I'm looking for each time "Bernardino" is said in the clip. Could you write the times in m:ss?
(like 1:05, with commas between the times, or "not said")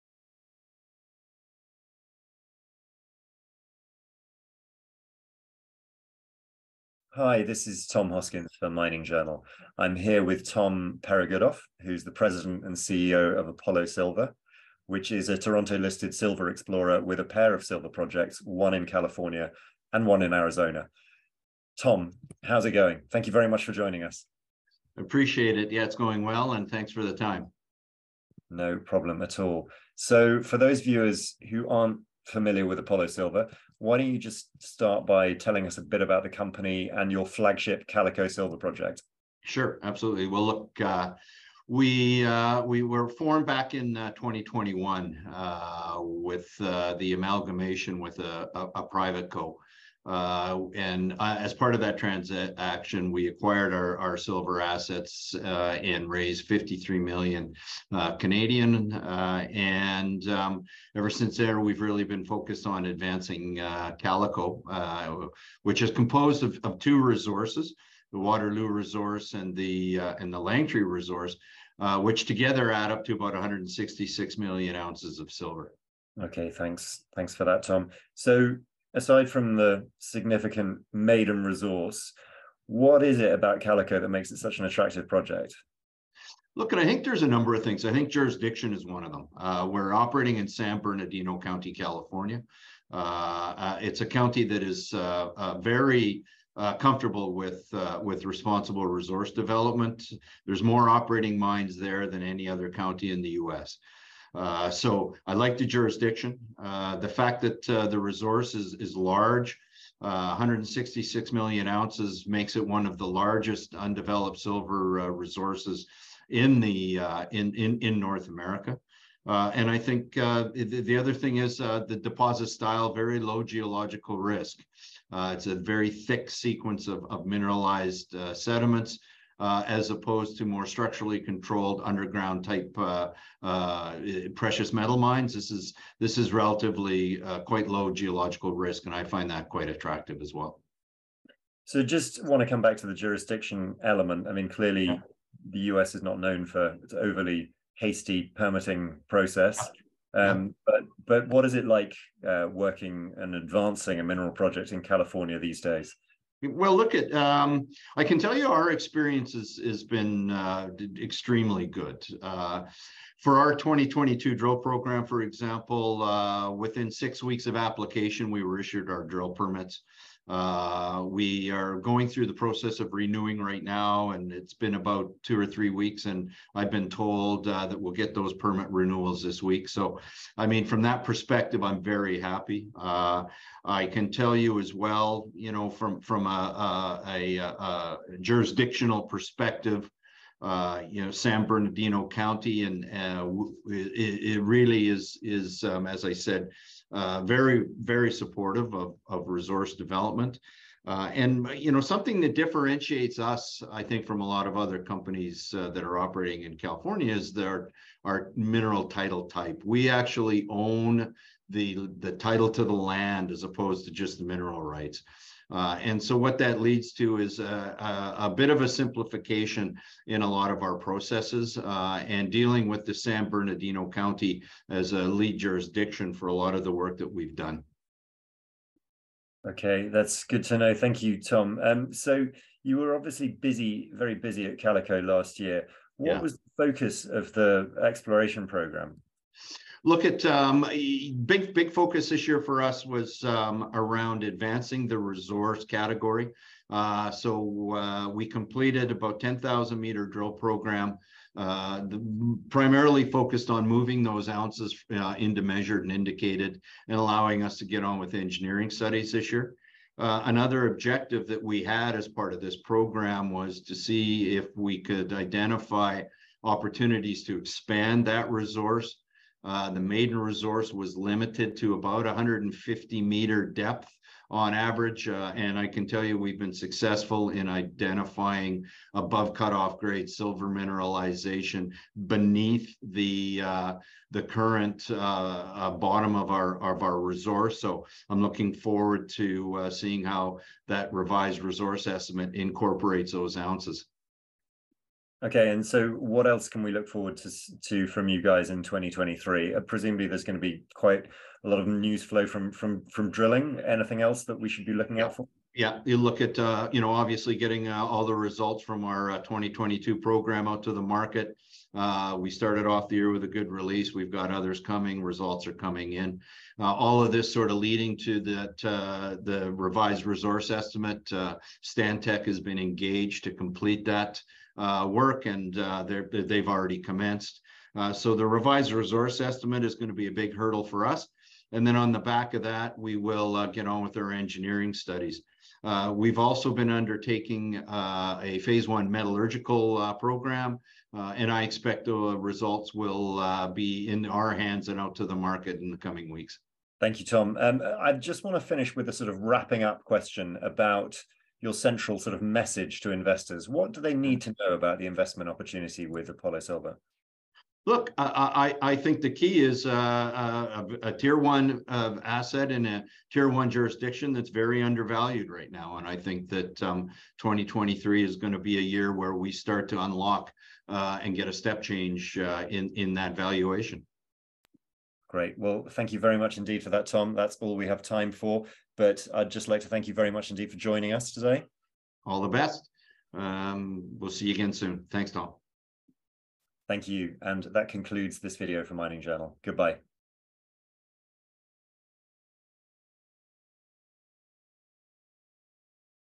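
1:30, 3:11, 3:43.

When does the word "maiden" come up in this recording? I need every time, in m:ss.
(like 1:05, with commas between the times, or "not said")
1:20, 4:29.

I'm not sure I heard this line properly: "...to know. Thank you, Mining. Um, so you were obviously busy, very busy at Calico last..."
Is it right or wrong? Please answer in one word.
wrong.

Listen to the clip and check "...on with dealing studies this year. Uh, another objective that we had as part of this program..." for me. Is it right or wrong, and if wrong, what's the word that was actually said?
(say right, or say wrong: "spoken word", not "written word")
wrong: "engineering", not "dealing".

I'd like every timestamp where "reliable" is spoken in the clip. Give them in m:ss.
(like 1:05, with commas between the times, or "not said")
not said.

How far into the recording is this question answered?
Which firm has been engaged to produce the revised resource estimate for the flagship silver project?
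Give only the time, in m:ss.
5:21.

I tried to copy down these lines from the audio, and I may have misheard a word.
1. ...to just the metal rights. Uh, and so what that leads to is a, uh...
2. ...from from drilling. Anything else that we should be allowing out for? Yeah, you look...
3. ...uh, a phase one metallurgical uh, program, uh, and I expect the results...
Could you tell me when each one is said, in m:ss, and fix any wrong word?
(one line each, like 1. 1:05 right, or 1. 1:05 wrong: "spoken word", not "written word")
1. 3:33 wrong: "mineral", not "metal"
2. 5:02 wrong: "looking", not "allowing"
3. 5:37 right.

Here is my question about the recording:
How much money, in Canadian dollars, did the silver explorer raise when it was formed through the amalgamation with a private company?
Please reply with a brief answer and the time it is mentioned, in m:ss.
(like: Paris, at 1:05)
53 million, at 0:56.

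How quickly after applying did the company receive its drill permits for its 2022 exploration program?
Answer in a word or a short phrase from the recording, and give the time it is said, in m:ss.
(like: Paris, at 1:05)
6 weeks, at 2:46.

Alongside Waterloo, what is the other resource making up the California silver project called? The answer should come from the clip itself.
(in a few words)
Langtree.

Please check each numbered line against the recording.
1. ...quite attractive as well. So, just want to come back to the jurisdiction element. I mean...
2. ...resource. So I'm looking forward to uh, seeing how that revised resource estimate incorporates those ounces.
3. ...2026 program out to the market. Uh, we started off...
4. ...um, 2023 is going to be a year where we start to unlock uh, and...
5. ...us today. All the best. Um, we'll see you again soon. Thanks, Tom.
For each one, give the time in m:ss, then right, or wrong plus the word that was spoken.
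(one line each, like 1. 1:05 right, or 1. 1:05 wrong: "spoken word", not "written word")
1. 2:19 right
2. 4:46 right
3. 5:09 wrong: "2022", not "2026"
4. 6:06 right
5. 6:20 right.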